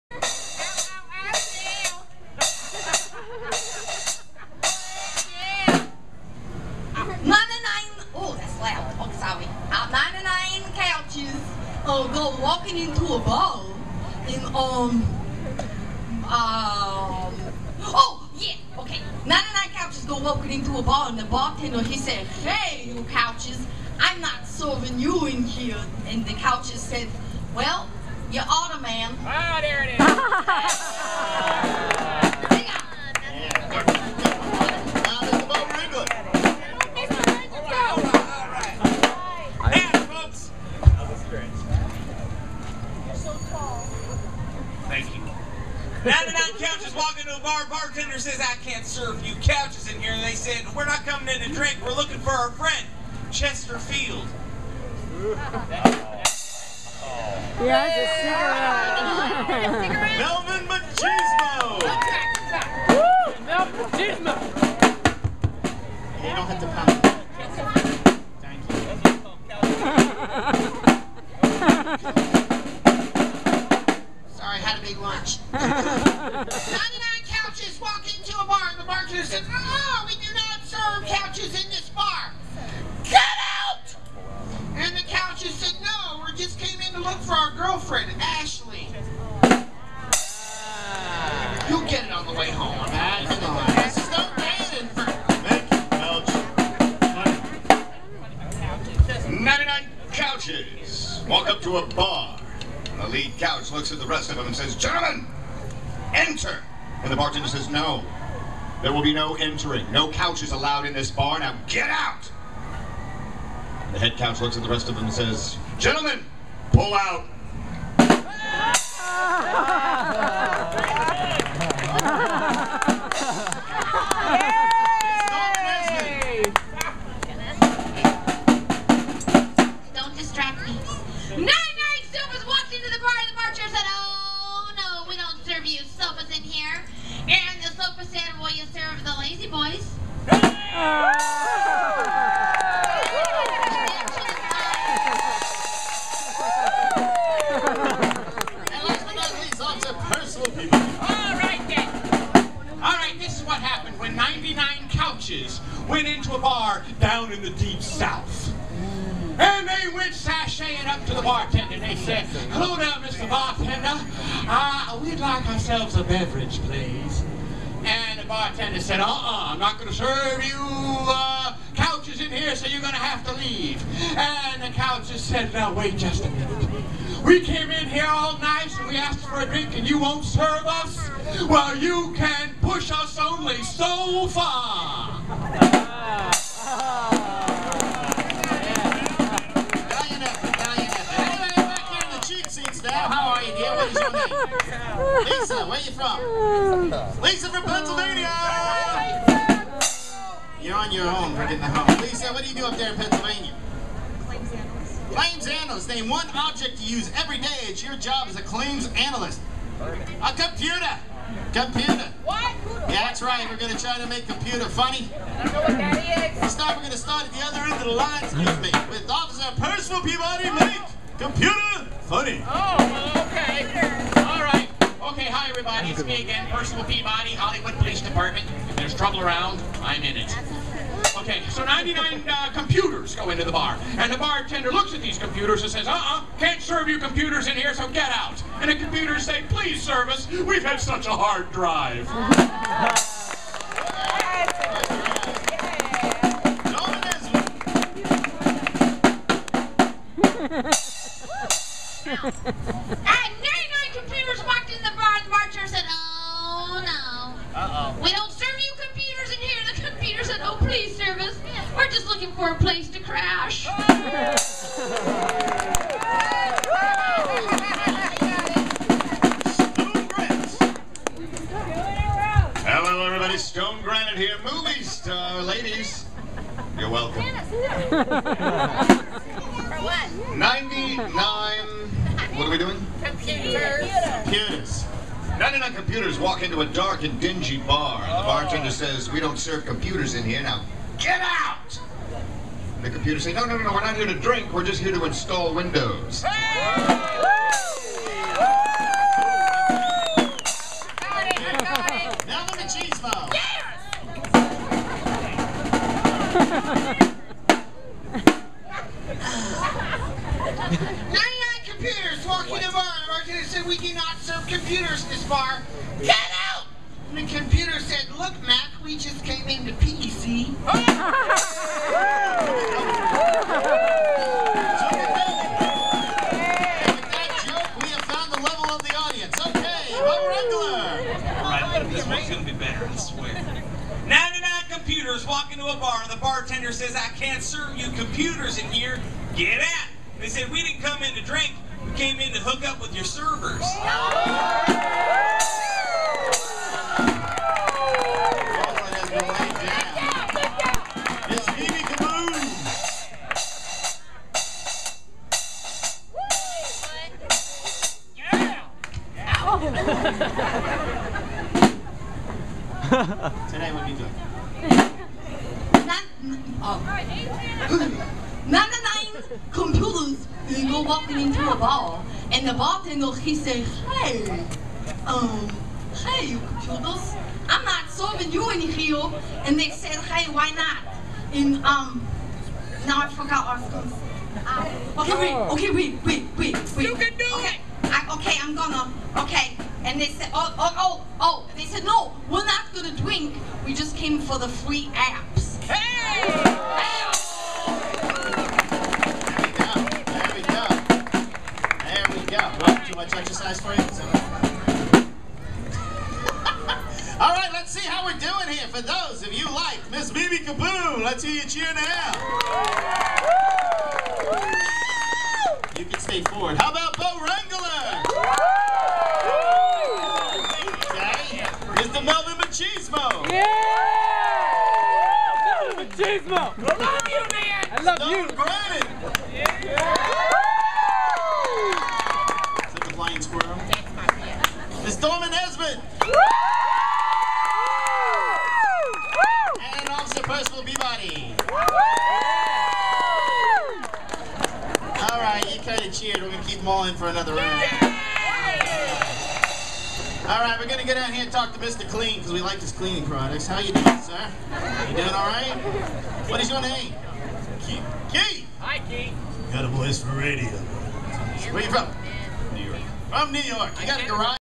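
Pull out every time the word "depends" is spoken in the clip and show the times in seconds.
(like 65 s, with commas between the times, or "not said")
not said.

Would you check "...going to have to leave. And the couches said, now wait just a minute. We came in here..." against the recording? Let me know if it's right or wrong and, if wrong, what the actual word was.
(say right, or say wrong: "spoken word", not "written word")
right.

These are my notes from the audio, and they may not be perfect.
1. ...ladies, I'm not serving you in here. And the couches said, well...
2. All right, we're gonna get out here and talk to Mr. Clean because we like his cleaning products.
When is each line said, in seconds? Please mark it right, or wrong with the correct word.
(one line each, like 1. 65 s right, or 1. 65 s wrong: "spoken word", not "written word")
1. 23 s wrong: "couches", not "ladies"
2. 450 s right.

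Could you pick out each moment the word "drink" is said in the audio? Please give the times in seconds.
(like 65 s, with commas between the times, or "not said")
51 s, 179 s, 294 s, 341 s, 392 s.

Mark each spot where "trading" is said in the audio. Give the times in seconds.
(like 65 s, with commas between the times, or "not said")
not said.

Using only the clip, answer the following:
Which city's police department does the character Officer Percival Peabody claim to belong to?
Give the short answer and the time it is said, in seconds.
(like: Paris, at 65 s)
Hollywood, at 227 s.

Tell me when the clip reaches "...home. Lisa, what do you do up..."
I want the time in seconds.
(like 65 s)
201 s.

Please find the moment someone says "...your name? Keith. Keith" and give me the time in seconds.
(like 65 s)
456 s.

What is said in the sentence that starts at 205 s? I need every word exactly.
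Name one object you use every day It's your job as a claims analyst.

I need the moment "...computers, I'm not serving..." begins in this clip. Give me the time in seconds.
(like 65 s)
376 s.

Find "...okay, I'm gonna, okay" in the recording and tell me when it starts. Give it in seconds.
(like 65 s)
388 s.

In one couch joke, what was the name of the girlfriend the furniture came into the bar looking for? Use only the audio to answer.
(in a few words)
Ashley.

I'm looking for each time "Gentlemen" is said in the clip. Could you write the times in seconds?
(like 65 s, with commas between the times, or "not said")
104 s, 115 s.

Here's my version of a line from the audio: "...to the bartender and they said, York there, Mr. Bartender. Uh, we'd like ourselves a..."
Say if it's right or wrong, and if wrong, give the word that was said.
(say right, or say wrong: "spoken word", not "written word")
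wrong: "Hello", not "York".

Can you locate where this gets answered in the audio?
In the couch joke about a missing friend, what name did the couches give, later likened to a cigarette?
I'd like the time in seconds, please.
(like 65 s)
53 s.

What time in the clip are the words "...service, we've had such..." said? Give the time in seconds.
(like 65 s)
239 s.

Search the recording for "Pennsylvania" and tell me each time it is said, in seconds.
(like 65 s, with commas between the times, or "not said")
197 s, 202 s.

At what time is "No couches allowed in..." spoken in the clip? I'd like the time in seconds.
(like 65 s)
109 s.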